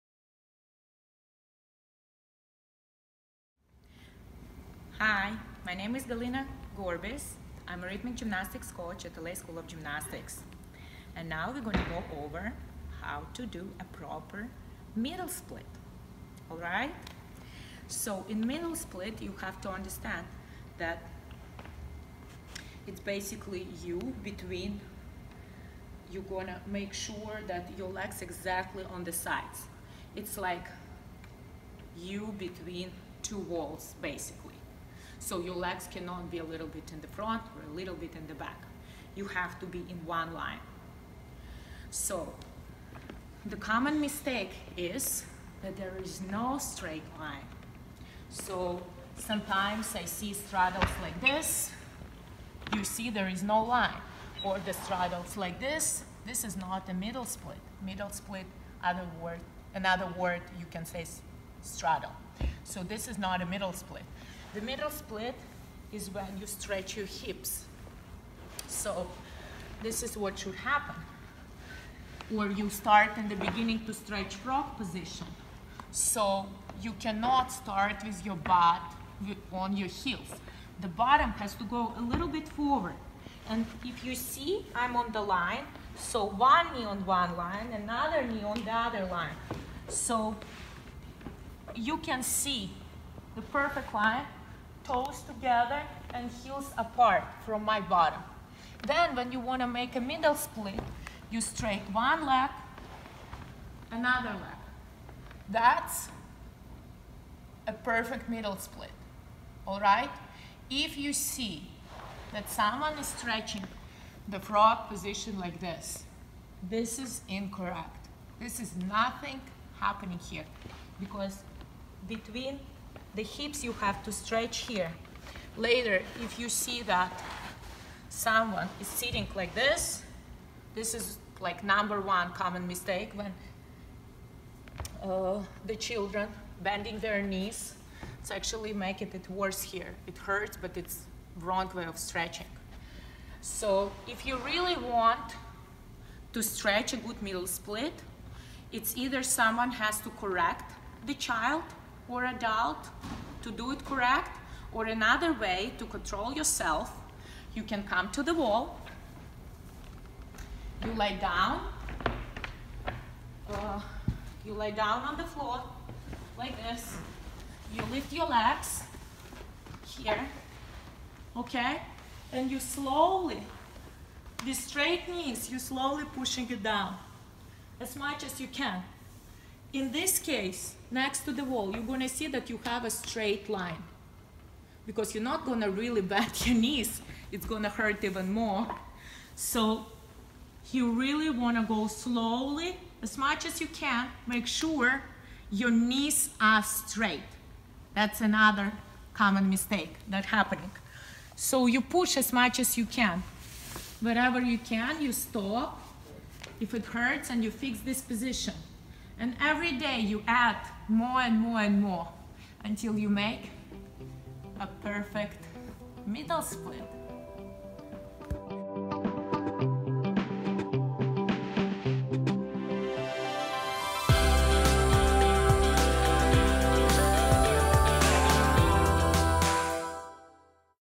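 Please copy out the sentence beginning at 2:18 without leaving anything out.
It's actually making it worse here.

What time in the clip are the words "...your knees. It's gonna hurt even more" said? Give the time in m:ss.
3:06.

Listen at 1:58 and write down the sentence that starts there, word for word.
This is nothing happening here because between the hips you have to stretch here.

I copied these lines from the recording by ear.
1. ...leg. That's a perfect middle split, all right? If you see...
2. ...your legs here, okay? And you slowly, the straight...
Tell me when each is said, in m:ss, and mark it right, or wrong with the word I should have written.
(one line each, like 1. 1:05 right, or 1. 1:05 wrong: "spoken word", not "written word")
1. 1:44 right
2. 2:48 right.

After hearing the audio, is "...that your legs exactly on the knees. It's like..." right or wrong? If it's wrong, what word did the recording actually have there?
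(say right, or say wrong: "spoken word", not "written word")
wrong: "sides", not "knees".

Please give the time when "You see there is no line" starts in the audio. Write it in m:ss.
0:52.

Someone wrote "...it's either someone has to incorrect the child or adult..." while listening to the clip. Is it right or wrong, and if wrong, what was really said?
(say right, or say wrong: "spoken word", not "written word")
wrong: "correct", not "incorrect".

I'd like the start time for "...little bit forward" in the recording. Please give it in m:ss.
1:22.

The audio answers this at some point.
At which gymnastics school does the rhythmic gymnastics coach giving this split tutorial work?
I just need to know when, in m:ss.
0:09.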